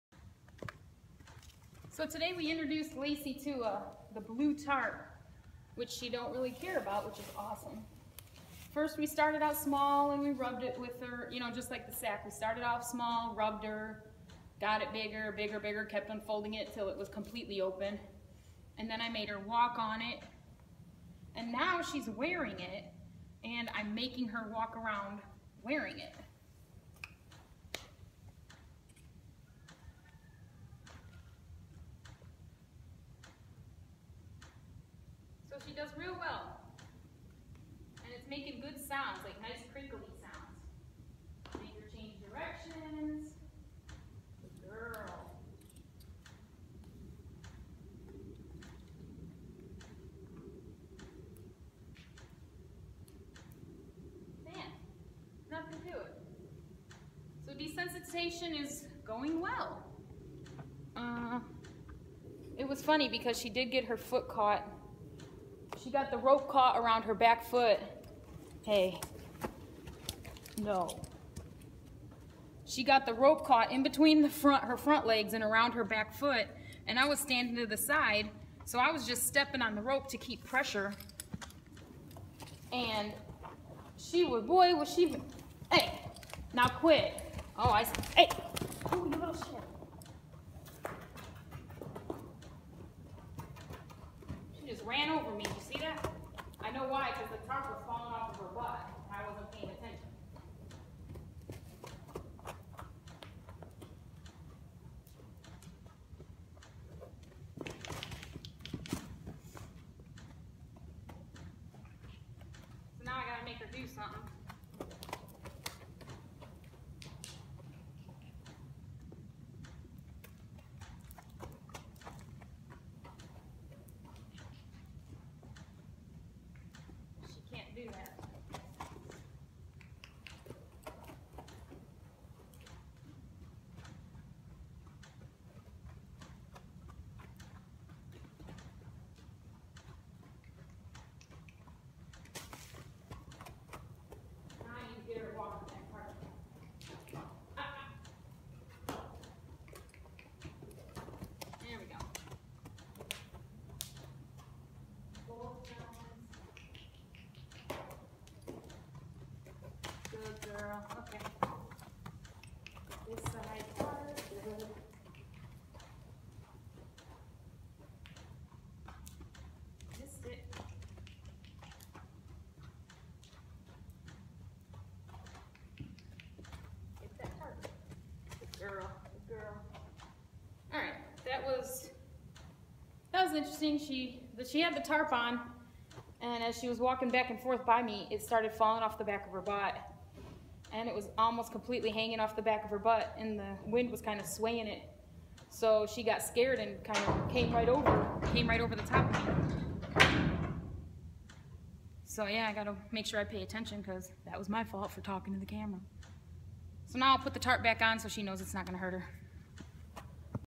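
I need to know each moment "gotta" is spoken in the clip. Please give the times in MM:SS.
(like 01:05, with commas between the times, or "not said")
01:53, 03:22.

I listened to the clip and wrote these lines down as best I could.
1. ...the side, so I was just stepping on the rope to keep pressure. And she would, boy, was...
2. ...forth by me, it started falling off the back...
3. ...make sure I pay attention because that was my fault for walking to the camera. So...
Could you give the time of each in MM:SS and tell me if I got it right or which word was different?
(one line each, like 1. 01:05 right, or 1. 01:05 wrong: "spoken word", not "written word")
1. 01:17 right
2. 03:07 right
3. 03:22 wrong: "talking", not "walking".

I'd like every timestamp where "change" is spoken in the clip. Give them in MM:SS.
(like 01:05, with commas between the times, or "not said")
00:41.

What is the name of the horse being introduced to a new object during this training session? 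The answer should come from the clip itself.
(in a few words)
Lacey.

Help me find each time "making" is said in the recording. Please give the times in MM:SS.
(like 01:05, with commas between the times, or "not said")
00:23, 00:38.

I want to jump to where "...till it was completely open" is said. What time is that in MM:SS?
00:16.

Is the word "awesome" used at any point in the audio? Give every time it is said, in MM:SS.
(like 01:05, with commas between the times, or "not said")
00:07.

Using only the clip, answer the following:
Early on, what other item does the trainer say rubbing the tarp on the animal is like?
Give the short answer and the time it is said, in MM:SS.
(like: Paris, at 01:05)
The sack, at 00:11.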